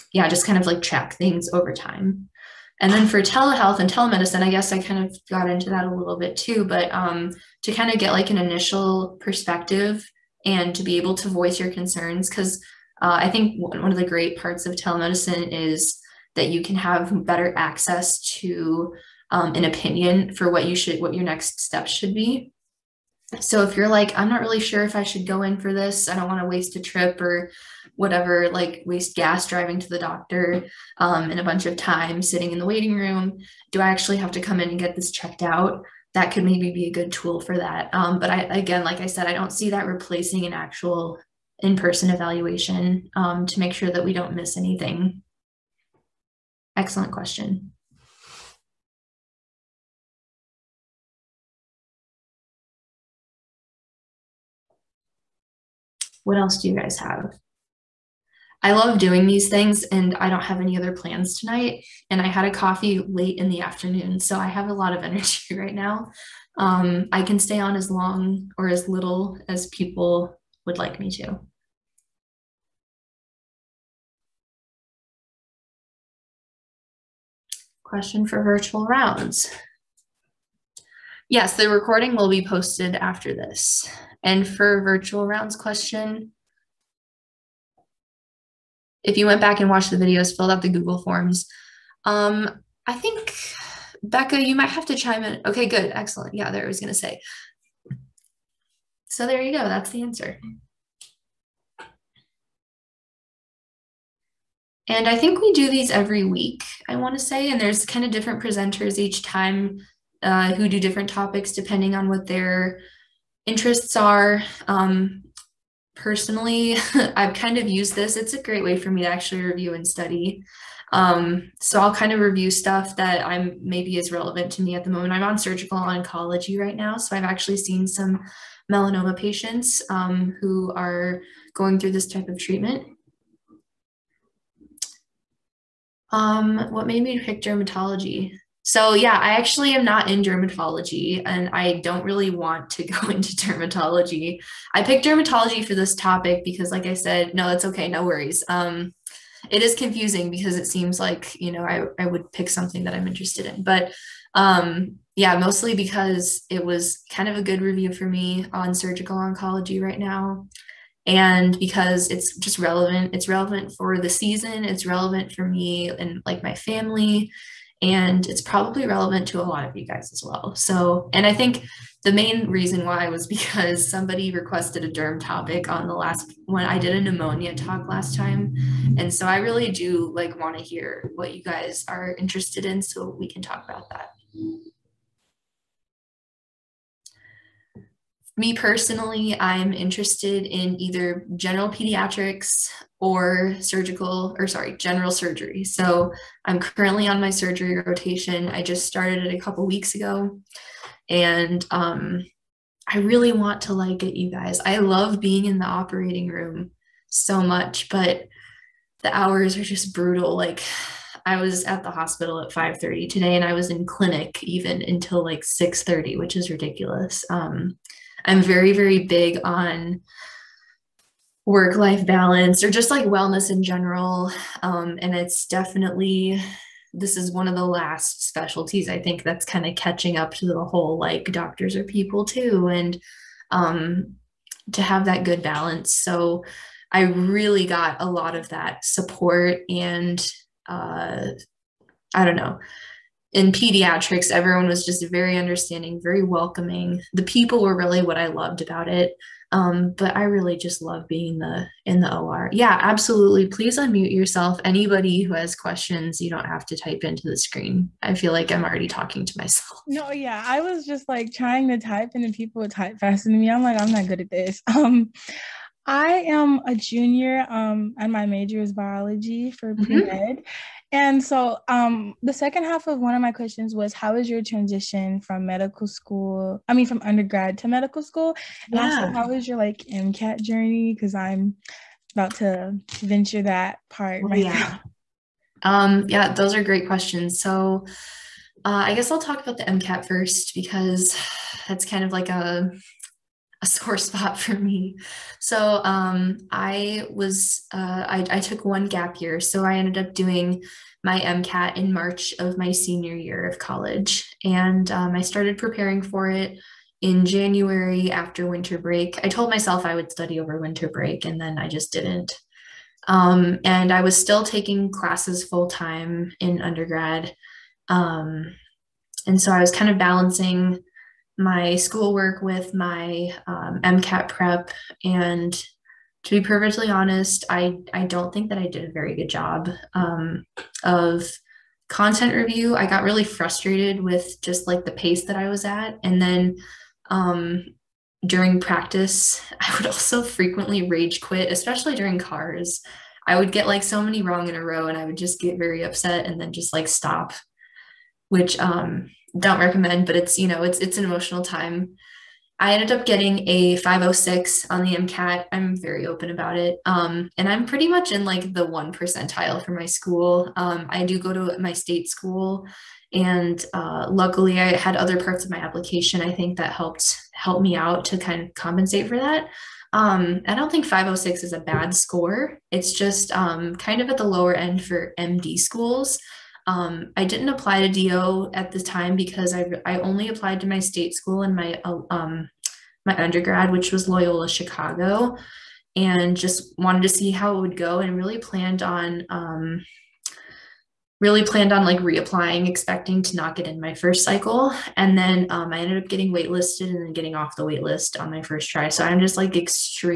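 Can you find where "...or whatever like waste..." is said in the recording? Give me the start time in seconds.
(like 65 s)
27 s.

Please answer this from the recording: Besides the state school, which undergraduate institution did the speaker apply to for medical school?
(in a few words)
Loyola Chicago.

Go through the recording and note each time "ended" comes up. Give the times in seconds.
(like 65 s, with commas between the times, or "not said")
299 s, 352 s, 395 s.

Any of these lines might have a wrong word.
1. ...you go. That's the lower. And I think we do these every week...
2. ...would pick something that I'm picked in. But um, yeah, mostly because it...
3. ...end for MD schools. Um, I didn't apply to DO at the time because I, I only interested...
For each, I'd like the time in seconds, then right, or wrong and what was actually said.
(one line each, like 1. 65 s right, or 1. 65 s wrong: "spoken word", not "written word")
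1. 99 s wrong: "answer", not "lower"
2. 152 s wrong: "interested", not "picked"
3. 374 s wrong: "applied", not "interested".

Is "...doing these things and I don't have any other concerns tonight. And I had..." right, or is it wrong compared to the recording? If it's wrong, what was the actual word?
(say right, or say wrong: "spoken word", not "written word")
wrong: "plans", not "concerns".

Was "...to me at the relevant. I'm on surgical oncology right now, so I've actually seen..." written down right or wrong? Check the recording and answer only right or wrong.
wrong.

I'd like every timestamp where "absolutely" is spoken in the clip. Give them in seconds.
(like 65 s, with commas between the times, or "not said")
252 s.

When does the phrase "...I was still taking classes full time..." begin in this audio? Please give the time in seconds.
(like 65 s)
313 s.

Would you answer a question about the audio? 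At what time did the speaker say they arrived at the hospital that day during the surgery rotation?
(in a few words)
5:30.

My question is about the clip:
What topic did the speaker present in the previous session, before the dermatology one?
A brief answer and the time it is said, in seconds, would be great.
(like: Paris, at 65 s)
pneumonia, at 177 s.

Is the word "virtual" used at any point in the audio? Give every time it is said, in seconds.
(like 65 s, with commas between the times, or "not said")
78 s, 84 s.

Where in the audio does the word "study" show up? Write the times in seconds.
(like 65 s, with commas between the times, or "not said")
119 s, 310 s.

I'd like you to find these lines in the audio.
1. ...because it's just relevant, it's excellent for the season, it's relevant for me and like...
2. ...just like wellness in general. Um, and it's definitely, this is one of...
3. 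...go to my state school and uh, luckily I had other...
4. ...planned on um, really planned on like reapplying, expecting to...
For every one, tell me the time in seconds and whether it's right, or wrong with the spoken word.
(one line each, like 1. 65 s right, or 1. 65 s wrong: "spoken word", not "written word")
1. 161 s wrong: "relevant", not "excellent"
2. 222 s right
3. 361 s right
4. 388 s right.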